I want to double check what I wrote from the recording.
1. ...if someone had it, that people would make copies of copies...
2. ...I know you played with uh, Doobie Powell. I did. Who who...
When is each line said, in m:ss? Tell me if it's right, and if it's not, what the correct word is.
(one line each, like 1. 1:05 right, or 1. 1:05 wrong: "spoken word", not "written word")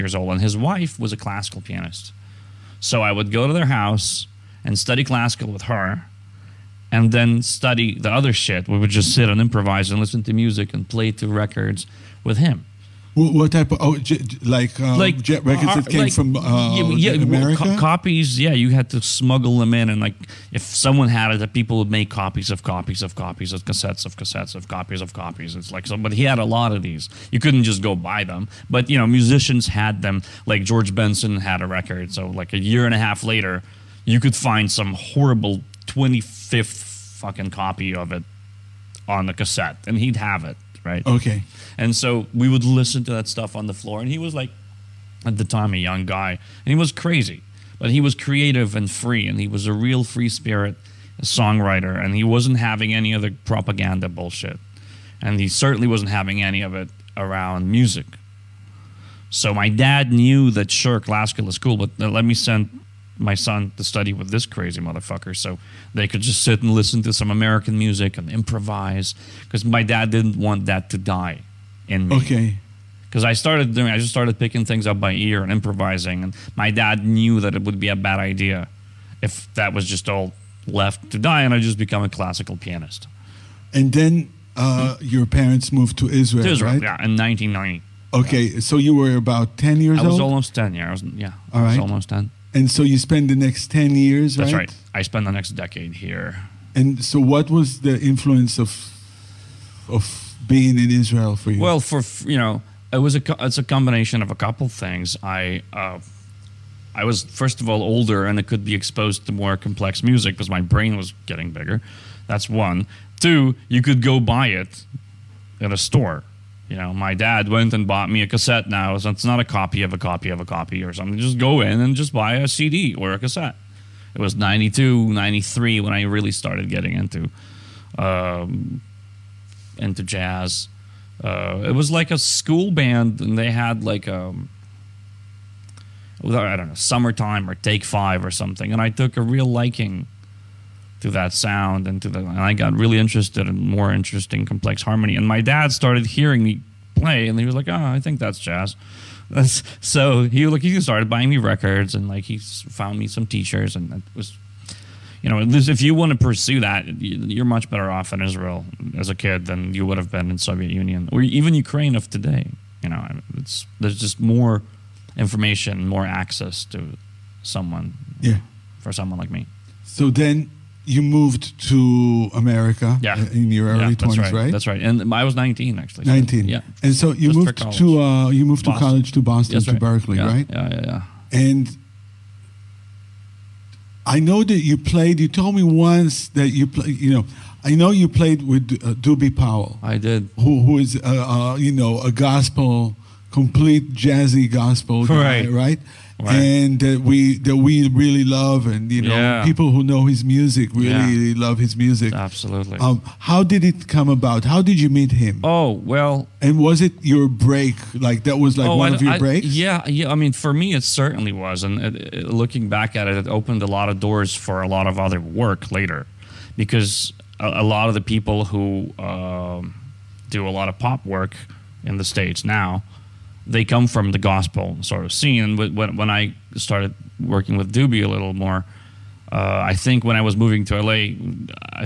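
1. 0:20 right
2. 3:07 right.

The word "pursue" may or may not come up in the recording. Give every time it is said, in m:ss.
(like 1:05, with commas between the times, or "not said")
2:36.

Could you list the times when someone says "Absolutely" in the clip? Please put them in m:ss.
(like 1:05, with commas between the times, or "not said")
3:22.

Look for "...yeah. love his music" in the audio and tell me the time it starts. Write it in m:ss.
3:21.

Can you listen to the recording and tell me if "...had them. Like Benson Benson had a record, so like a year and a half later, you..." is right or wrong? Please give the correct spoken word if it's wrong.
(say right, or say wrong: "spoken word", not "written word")
wrong: "George", not "Benson".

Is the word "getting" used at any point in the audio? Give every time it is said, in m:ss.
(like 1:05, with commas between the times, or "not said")
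1:51, 2:06.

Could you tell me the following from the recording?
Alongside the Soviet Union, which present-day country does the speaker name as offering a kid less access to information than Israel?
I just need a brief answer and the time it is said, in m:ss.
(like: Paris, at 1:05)
Ukraine, at 2:41.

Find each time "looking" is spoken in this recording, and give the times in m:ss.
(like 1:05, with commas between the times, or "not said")
3:32.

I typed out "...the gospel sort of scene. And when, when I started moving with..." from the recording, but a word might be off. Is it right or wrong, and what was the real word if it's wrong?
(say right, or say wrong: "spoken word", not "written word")
wrong: "working", not "moving".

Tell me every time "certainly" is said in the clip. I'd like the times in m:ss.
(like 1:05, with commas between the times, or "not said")
0:55, 3:30.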